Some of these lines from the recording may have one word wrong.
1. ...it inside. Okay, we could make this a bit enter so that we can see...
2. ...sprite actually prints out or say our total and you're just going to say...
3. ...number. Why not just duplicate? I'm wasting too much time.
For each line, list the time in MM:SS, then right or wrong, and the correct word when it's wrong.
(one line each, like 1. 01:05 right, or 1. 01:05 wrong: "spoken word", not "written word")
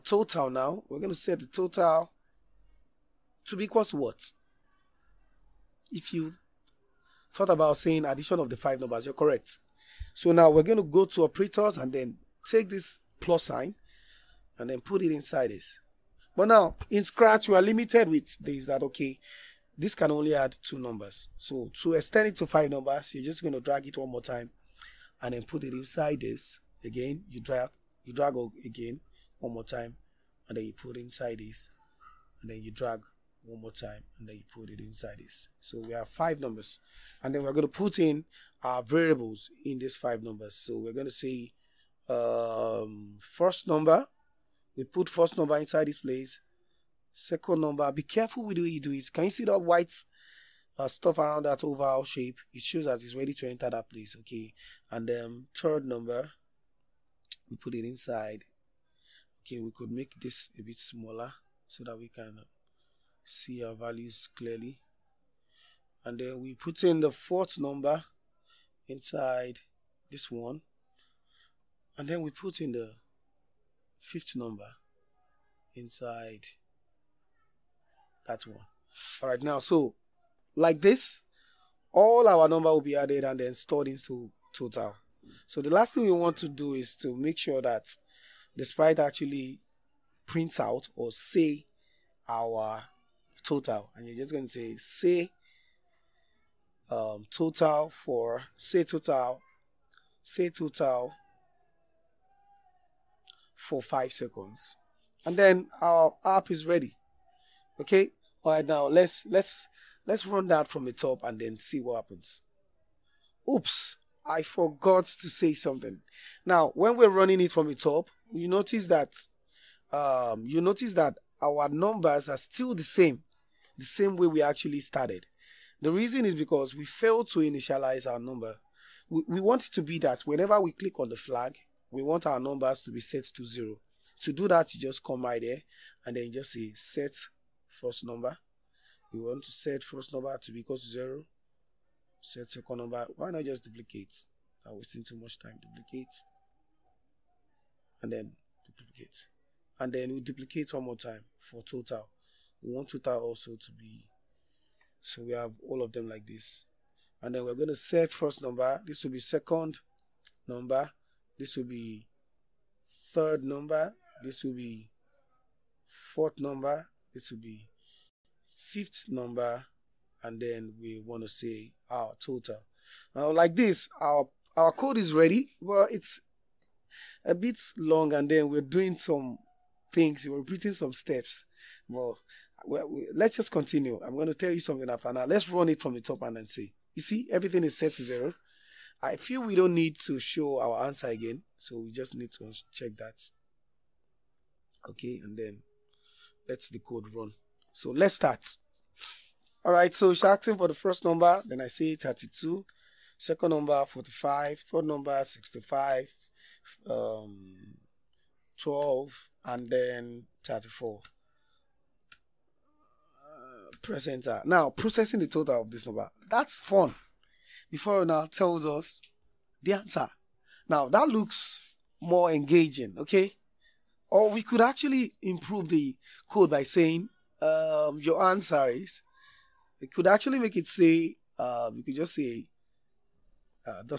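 1. 00:57 wrong: "smaller", not "enter"
2. 01:28 right
3. 02:22 right.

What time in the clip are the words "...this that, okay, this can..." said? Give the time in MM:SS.
00:18.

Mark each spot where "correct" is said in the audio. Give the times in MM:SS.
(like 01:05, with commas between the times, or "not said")
00:09.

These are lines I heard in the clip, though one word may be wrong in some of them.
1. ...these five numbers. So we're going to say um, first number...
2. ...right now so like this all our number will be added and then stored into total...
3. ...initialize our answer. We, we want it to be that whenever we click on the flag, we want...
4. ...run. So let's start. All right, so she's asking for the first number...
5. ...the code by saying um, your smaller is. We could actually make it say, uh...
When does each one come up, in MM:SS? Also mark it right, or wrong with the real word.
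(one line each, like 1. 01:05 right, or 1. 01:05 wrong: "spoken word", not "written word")
1. 00:39 right
2. 01:19 right
3. 02:07 wrong: "number", not "answer"
4. 03:17 right
5. 03:45 wrong: "answer", not "smaller".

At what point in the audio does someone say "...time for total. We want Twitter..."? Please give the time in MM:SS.
02:30.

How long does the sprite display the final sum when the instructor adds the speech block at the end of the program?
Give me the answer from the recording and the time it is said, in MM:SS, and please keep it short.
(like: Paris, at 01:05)
5 seconds, at 01:43.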